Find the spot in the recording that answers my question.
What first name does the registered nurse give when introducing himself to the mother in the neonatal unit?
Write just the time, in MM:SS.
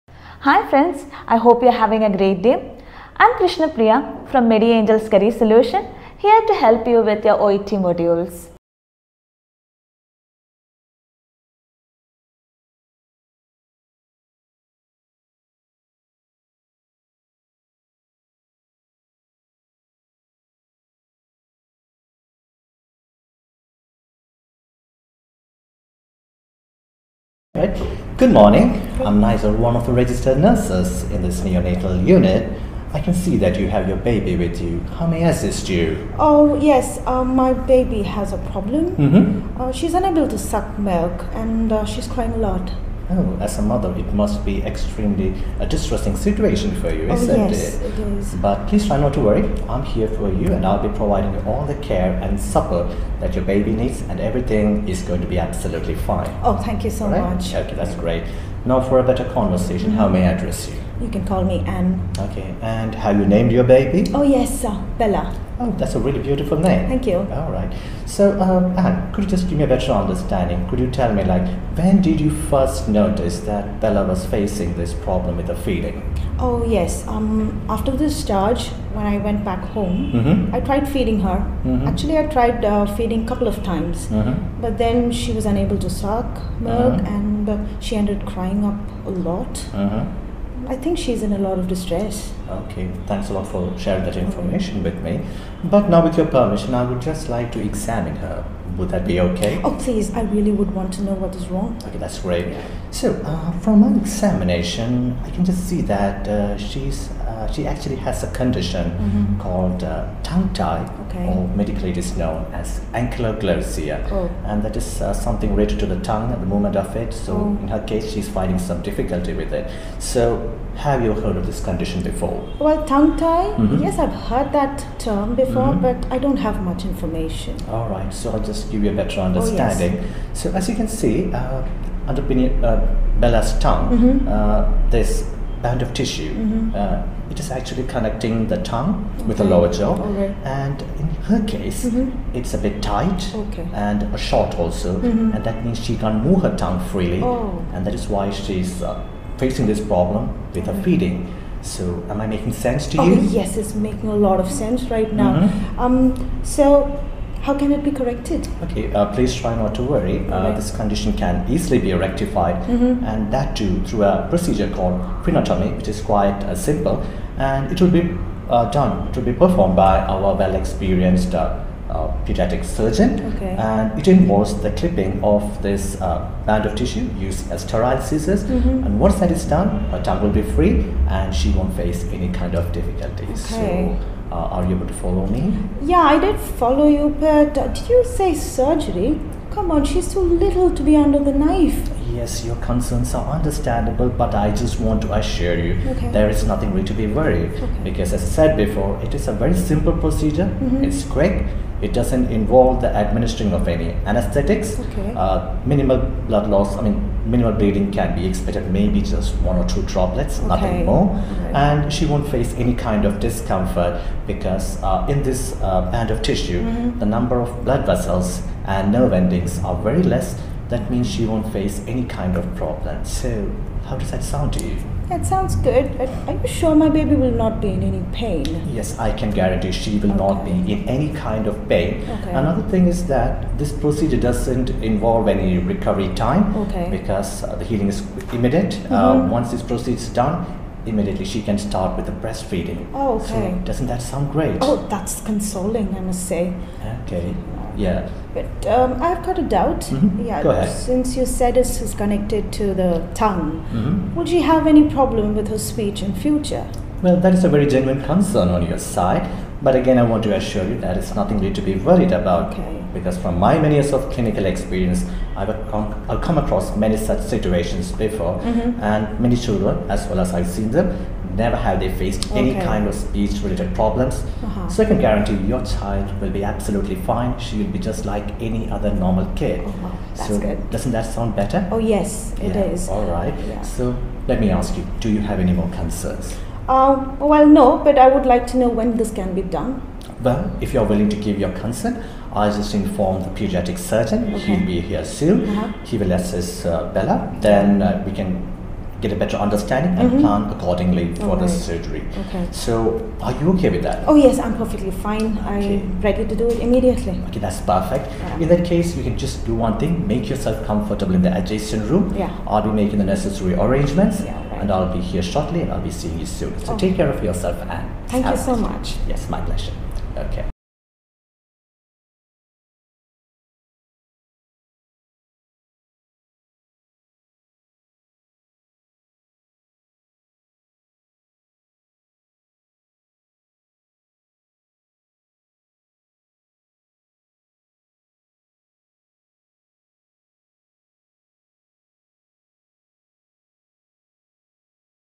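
00:29.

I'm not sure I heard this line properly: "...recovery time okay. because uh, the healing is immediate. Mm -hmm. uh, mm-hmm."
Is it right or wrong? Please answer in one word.
right.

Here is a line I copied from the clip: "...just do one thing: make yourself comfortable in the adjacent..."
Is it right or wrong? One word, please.
right.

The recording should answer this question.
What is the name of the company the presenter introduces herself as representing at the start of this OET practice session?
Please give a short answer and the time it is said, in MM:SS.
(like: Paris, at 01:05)
Angels Career Solution, at 00:04.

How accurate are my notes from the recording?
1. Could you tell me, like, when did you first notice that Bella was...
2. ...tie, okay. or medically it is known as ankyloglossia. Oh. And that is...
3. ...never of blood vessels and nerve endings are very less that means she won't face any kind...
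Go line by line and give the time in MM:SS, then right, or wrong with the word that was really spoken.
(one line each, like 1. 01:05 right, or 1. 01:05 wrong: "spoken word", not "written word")
1. 01:10 right
2. 01:50 right
3. 03:37 wrong: "number", not "never".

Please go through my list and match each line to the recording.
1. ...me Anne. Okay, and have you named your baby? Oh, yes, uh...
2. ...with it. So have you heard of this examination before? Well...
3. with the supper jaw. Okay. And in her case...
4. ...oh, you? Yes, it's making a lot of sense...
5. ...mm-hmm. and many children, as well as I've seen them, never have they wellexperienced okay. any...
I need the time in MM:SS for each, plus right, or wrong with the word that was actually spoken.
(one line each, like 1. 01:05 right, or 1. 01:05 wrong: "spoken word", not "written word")
1. 01:01 right
2. 01:59 wrong: "condition", not "examination"
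3. 02:19 wrong: "lower", not "supper"
4. 02:32 right
5. 04:28 wrong: "faced", not "wellexperienced".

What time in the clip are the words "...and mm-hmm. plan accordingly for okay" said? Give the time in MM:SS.
04:59.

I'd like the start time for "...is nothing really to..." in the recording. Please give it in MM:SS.
03:16.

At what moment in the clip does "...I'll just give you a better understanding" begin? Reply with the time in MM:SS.
02:08.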